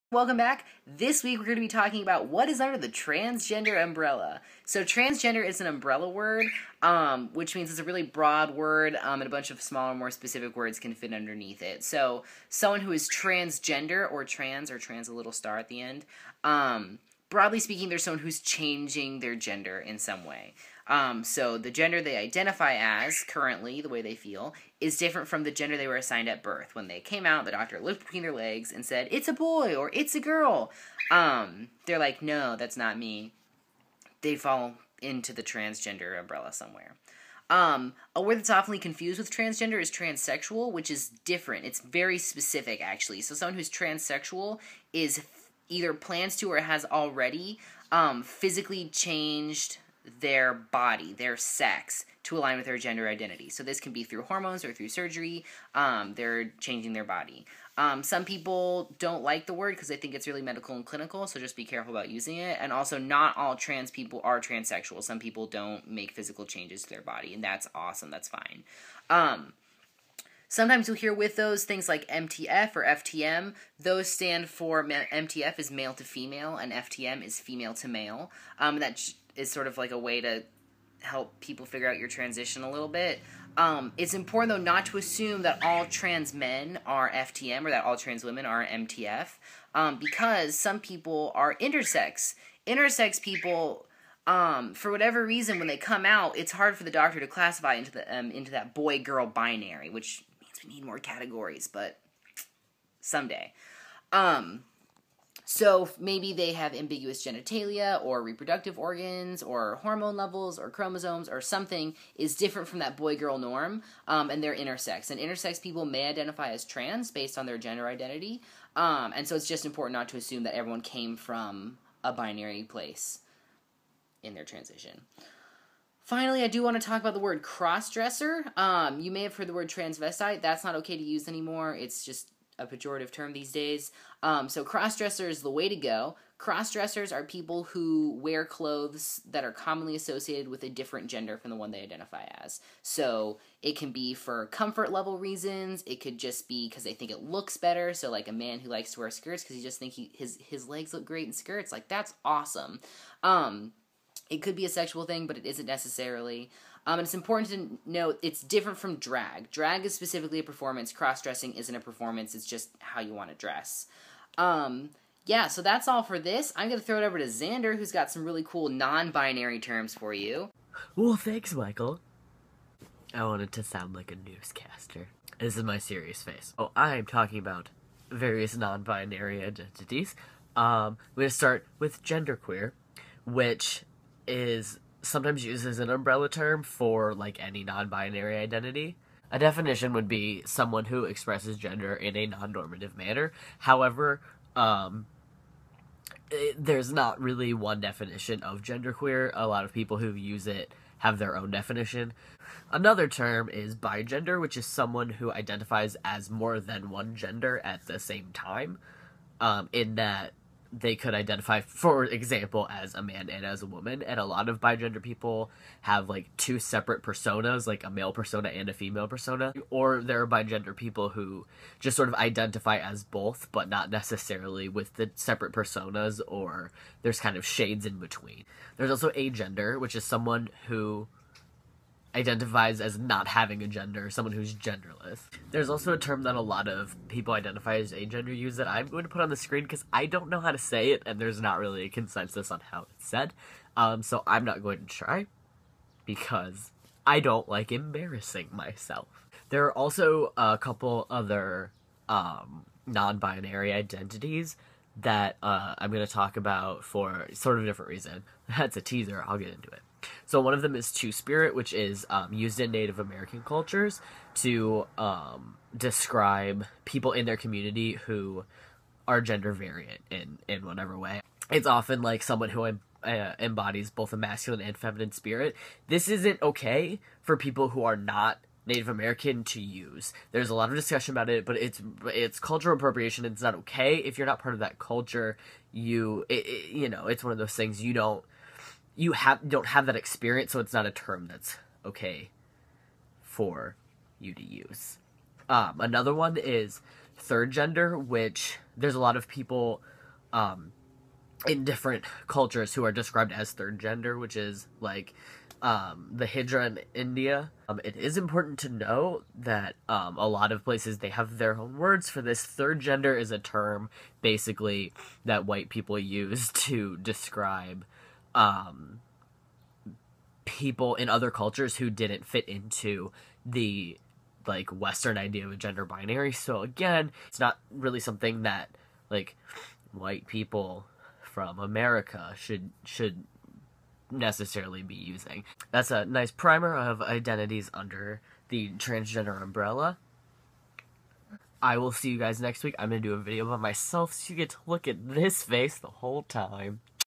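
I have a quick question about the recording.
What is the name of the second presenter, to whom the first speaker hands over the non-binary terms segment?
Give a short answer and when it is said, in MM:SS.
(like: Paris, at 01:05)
Xander, at 02:47.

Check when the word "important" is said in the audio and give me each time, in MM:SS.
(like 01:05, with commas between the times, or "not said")
01:24, 01:59, 02:37, 05:08.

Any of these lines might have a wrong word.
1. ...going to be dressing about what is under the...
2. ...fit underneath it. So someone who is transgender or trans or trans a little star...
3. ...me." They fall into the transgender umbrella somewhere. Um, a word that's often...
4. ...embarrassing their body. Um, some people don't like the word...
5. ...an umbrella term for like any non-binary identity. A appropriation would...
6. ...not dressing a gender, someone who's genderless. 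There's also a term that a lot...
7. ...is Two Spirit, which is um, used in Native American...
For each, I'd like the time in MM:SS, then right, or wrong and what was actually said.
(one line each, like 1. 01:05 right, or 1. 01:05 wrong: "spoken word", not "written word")
1. 00:01 wrong: "talking", not "dressing"
2. 00:10 right
3. 00:32 right
4. 00:56 wrong: "changing", not "embarrassing"
5. 03:05 wrong: "definition", not "appropriation"
6. 03:52 wrong: "having", not "dressing"
7. 04:20 right.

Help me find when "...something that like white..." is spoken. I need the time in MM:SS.
05:27.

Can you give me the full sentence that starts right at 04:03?
Um, so I'm not going to try because I don't like embarrassing myself.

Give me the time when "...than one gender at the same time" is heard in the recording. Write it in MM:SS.
03:26.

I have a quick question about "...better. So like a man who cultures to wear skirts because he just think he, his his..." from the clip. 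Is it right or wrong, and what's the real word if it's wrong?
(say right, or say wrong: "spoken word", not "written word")
wrong: "likes", not "cultures".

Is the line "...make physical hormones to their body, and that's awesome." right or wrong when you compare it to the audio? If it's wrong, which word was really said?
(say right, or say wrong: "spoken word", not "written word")
wrong: "changes", not "hormones".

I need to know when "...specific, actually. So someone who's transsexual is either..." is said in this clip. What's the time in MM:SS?
00:42.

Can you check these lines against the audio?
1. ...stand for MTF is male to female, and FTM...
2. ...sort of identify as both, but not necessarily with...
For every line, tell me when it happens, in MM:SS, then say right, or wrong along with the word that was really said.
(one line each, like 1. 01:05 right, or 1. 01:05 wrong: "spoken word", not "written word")
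1. 01:14 right
2. 03:41 right.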